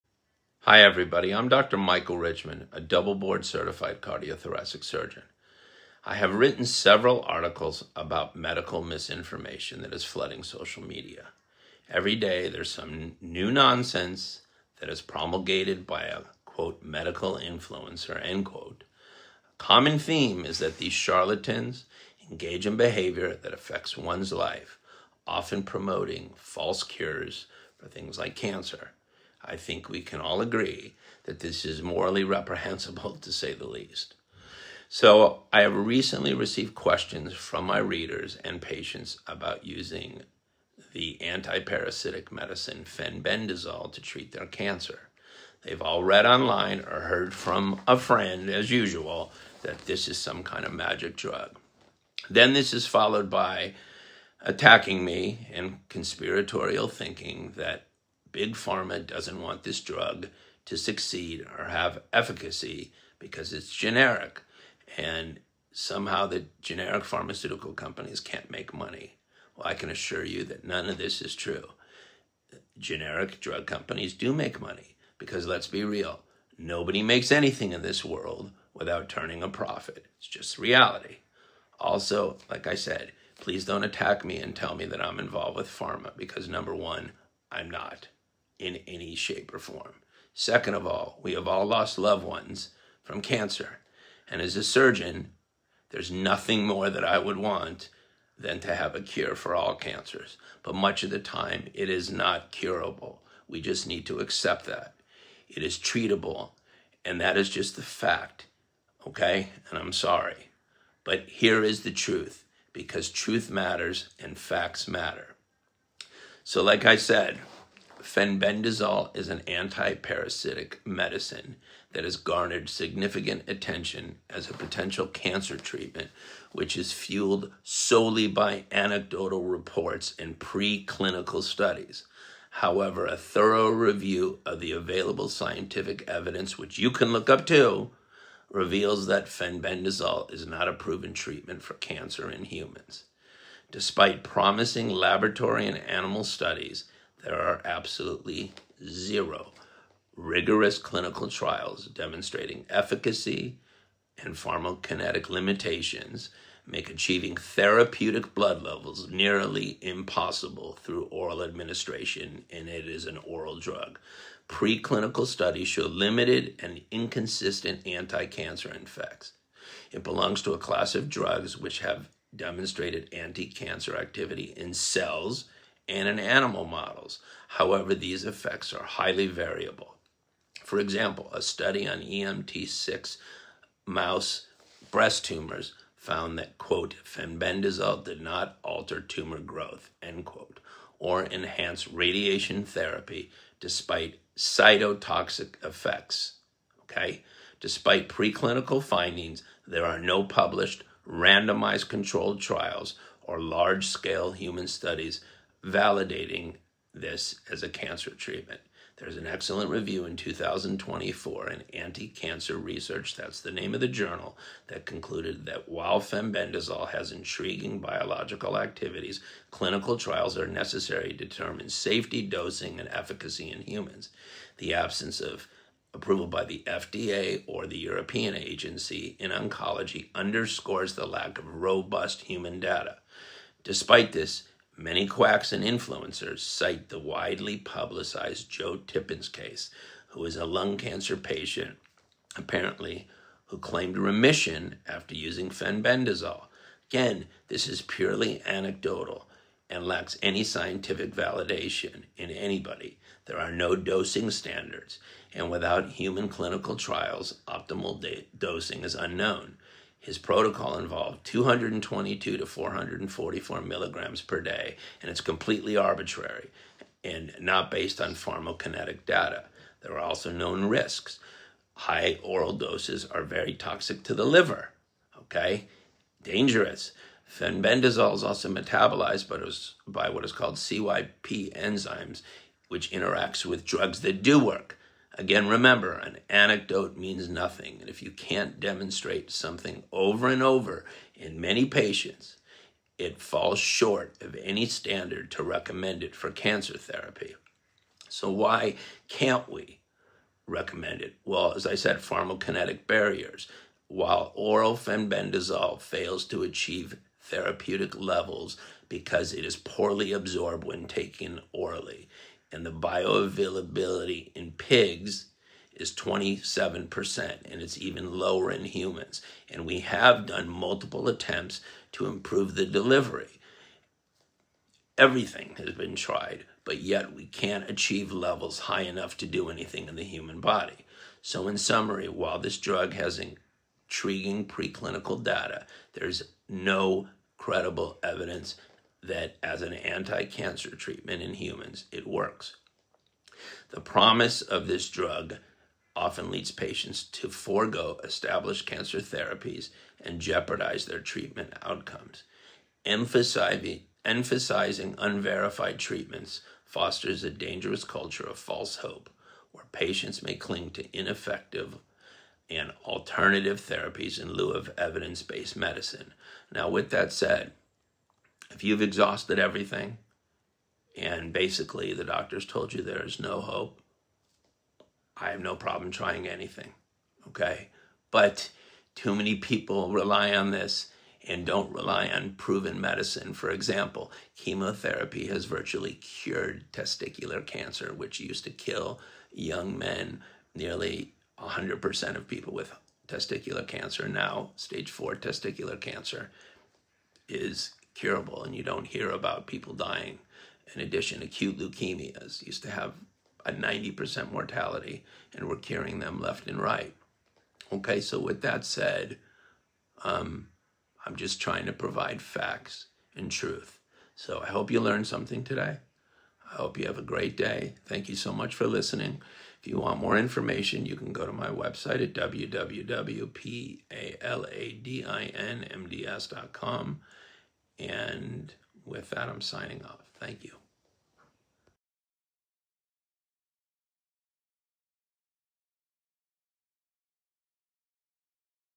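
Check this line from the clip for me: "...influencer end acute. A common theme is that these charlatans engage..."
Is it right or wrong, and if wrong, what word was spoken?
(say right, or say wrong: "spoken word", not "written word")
wrong: "quote", not "acute".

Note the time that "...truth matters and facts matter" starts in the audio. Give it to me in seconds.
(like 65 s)
113 s.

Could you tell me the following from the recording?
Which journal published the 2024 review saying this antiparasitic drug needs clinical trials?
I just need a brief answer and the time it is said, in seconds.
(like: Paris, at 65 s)
Anti Cancer Research, at 211 s.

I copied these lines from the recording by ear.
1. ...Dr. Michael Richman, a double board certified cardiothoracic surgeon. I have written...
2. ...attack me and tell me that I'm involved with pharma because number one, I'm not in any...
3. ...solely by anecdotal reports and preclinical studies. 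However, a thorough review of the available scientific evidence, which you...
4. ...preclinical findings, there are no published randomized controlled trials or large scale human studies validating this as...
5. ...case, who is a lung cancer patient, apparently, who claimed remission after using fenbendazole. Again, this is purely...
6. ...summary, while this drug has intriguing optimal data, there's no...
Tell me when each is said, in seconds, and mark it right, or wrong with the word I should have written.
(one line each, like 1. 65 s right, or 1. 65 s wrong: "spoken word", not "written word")
1. 1 s right
2. 83 s right
3. 127 s right
4. 198 s right
5. 239 s right
6. 331 s wrong: "preclinical", not "optimal".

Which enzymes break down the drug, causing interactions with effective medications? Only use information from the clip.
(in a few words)
CYP enzymes.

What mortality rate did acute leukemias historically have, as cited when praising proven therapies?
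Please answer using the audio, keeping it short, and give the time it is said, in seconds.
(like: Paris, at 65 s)
90%, at 403 s.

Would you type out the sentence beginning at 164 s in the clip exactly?
Preclinical studies show limited and inconsistent anti cancer effects.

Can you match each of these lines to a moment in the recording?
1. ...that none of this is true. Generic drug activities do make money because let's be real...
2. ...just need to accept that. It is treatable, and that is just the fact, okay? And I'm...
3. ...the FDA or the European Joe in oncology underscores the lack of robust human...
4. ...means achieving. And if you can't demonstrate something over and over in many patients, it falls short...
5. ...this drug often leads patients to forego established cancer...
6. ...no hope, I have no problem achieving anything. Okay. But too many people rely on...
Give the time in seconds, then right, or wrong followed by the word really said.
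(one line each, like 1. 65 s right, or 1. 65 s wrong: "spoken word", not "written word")
1. 70 s wrong: "companies", not "activities"
2. 103 s right
3. 226 s wrong: "Agency", not "Joe"
4. 286 s wrong: "nothing", not "achieving"
5. 344 s right
6. 373 s wrong: "trying", not "achieving".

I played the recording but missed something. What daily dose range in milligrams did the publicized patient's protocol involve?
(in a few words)
222 to 444 milligrams.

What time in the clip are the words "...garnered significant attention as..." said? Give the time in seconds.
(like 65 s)
122 s.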